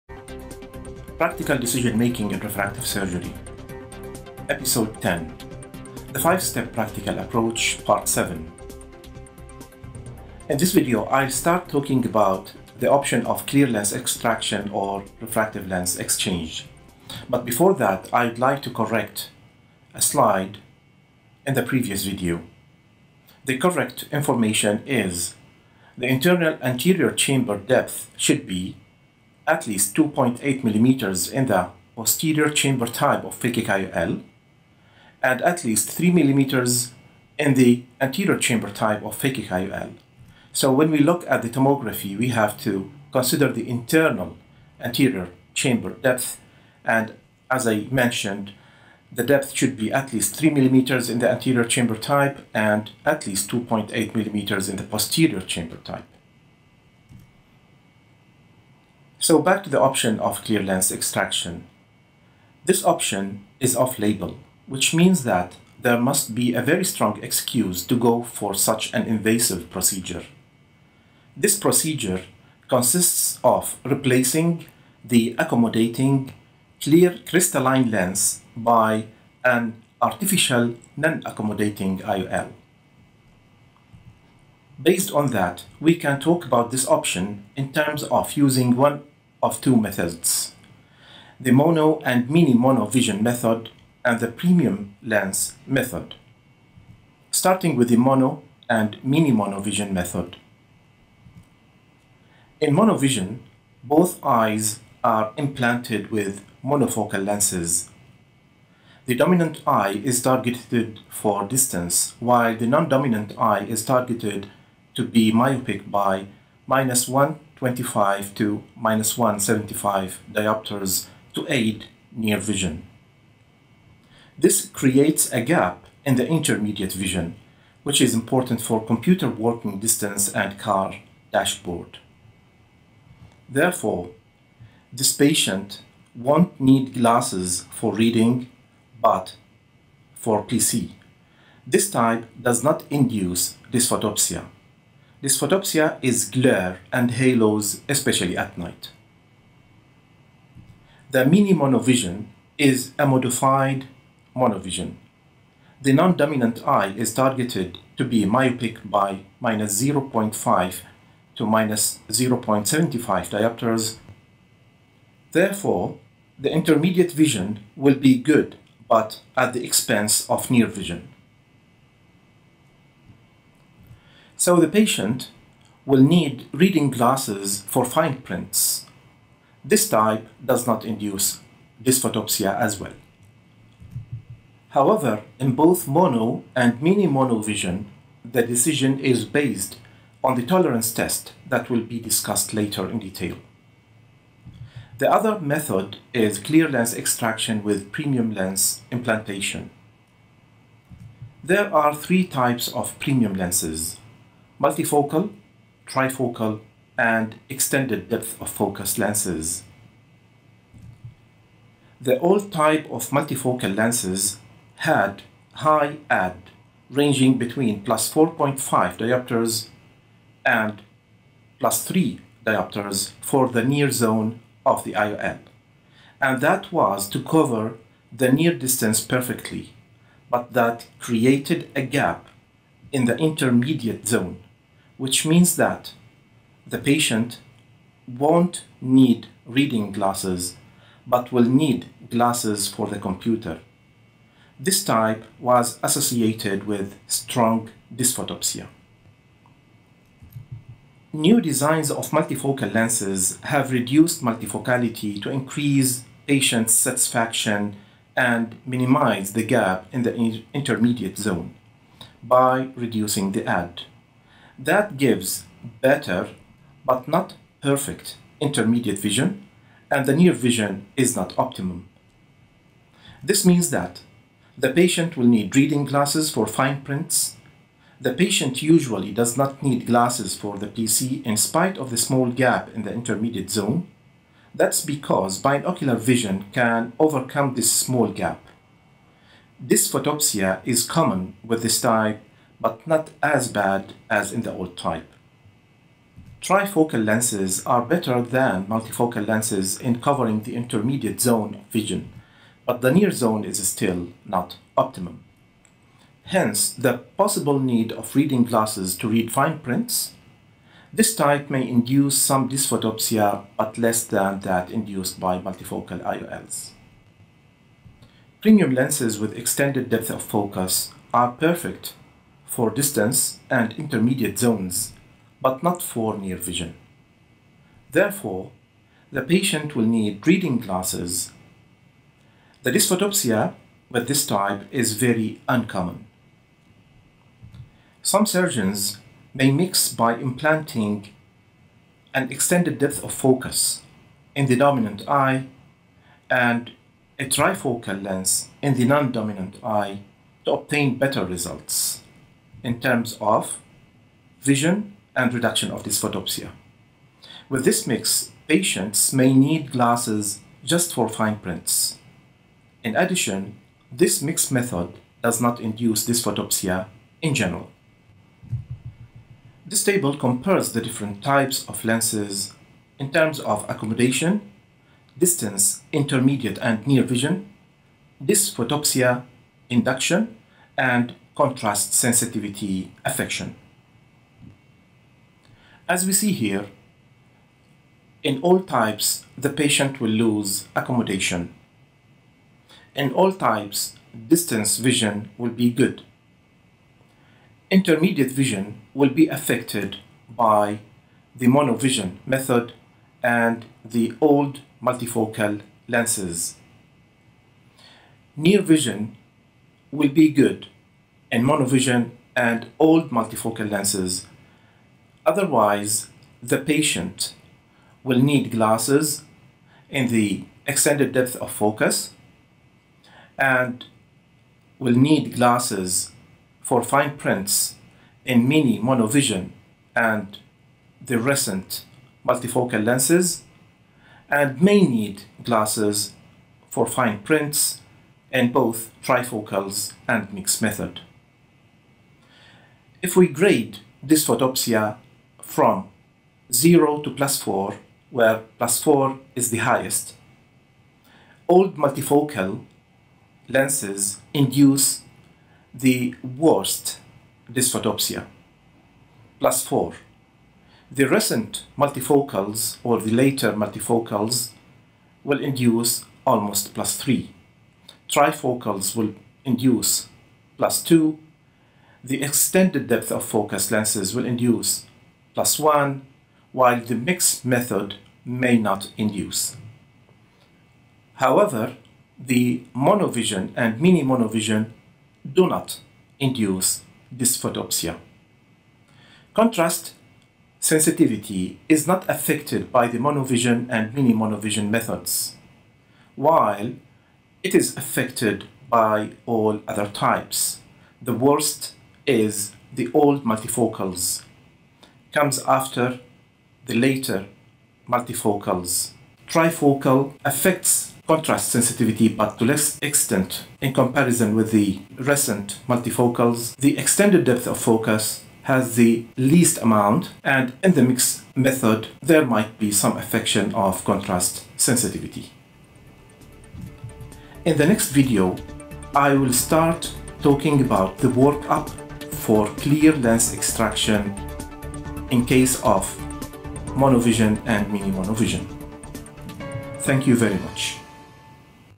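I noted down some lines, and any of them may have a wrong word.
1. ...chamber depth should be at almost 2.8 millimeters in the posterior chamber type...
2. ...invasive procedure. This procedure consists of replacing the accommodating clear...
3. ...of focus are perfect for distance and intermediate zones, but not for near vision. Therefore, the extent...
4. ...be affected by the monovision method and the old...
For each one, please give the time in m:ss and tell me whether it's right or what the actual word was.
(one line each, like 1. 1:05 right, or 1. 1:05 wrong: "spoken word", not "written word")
1. 0:27 wrong: "least", not "almost"
2. 1:09 right
3. 5:20 wrong: "patient", not "extent"
4. 6:39 right.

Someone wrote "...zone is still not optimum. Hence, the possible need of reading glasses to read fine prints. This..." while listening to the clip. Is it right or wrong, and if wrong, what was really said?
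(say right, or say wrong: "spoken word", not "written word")
right.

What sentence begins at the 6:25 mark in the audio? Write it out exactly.
As we see here, in all types, the patient will lose accommodation.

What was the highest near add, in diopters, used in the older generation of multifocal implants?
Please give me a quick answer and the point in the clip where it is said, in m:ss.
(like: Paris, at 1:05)
+4.5 D, at 3:37.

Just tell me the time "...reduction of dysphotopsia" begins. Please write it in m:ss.
5:55.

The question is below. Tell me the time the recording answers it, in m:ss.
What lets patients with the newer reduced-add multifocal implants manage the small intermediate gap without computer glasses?
4:45.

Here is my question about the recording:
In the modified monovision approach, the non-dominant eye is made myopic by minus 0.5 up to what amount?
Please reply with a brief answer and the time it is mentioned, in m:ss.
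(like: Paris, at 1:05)
-0.75 D, at 2:41.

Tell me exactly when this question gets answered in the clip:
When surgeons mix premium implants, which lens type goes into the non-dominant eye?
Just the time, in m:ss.
5:47.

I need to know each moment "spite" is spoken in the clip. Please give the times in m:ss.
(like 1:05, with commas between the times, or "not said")
4:41.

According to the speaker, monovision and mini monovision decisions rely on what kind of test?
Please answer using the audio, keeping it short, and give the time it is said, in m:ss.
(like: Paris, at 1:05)
Tolerance test, at 3:10.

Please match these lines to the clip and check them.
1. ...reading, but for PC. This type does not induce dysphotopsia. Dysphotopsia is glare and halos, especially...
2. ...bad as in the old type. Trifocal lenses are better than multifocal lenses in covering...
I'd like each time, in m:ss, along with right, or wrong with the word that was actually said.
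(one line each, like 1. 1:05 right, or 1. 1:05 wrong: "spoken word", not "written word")
1. 2:17 right
2. 4:53 right.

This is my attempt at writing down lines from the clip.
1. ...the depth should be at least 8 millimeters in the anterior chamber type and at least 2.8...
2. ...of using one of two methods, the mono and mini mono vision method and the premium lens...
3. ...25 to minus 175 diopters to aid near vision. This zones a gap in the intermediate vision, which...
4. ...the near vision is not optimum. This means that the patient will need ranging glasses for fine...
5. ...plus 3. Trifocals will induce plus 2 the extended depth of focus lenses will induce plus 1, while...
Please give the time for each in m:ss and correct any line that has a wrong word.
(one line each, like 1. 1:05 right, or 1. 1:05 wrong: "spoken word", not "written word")
1. 0:49 wrong: "3", not "8"
2. 1:28 right
3. 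1:57 wrong: "creates", not "zones"
4. 4:30 wrong: "reading", not "ranging"
5. 7:46 right.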